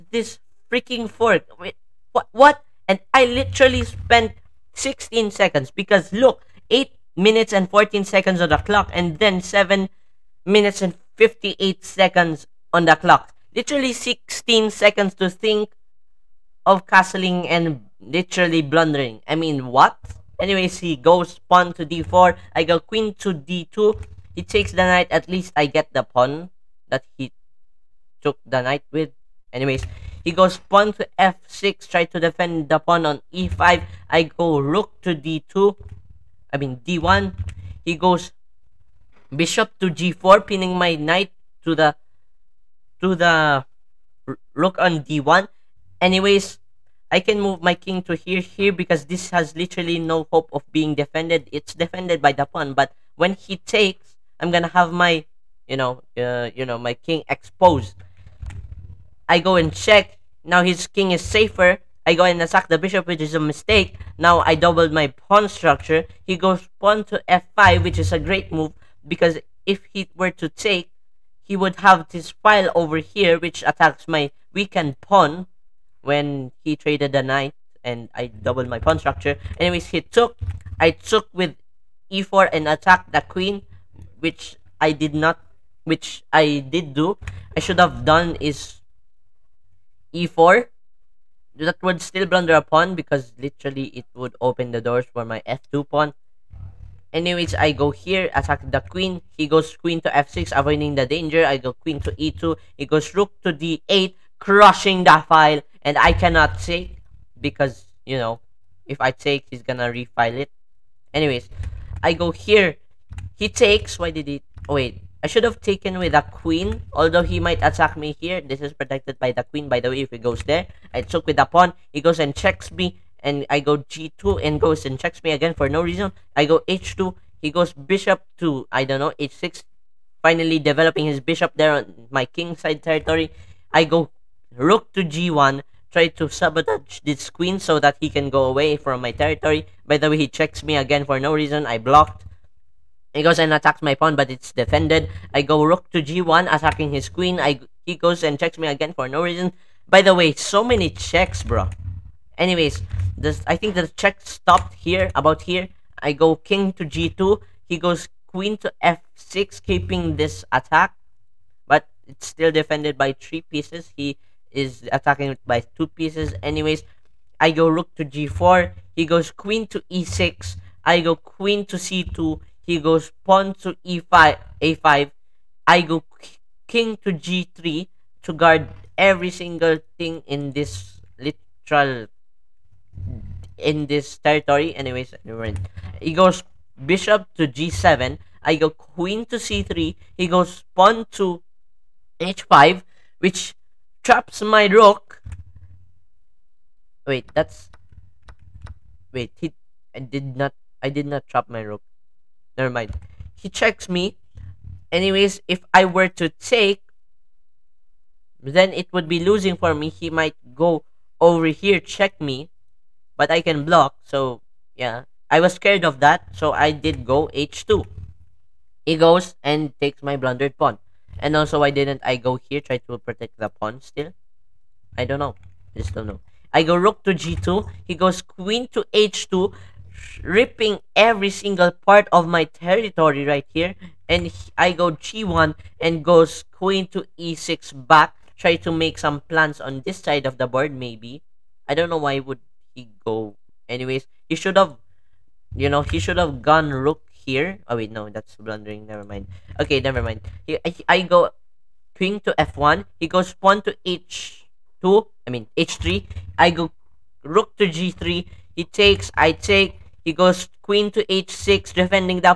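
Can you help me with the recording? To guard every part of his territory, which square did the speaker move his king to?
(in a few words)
g3.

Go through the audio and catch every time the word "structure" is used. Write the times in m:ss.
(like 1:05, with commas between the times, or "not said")
1:05, 1:18.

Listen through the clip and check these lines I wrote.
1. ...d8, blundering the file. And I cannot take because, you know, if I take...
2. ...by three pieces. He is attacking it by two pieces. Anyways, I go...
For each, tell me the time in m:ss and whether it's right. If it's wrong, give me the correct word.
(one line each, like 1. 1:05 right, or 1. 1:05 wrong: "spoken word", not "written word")
1. 1:43 wrong: "crushing", not "blundering"
2. 2:42 right.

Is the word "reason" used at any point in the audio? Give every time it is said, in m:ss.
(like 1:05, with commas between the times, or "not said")
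2:05, 2:21, 2:29.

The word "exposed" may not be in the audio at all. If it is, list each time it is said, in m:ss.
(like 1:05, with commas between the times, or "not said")
0:57.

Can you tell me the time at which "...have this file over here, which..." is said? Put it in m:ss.
1:11.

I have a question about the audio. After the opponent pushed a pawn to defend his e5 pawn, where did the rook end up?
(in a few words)
d1.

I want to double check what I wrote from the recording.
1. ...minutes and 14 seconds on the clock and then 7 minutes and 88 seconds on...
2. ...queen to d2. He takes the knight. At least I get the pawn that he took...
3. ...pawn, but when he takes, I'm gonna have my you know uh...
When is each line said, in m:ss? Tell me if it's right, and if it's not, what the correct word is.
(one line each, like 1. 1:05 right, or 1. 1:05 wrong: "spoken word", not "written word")
1. 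0:07 wrong: "58", not "88"
2. 0:22 right
3. 0:52 right.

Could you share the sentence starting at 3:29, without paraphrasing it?
He might go over here, check me, but I can block.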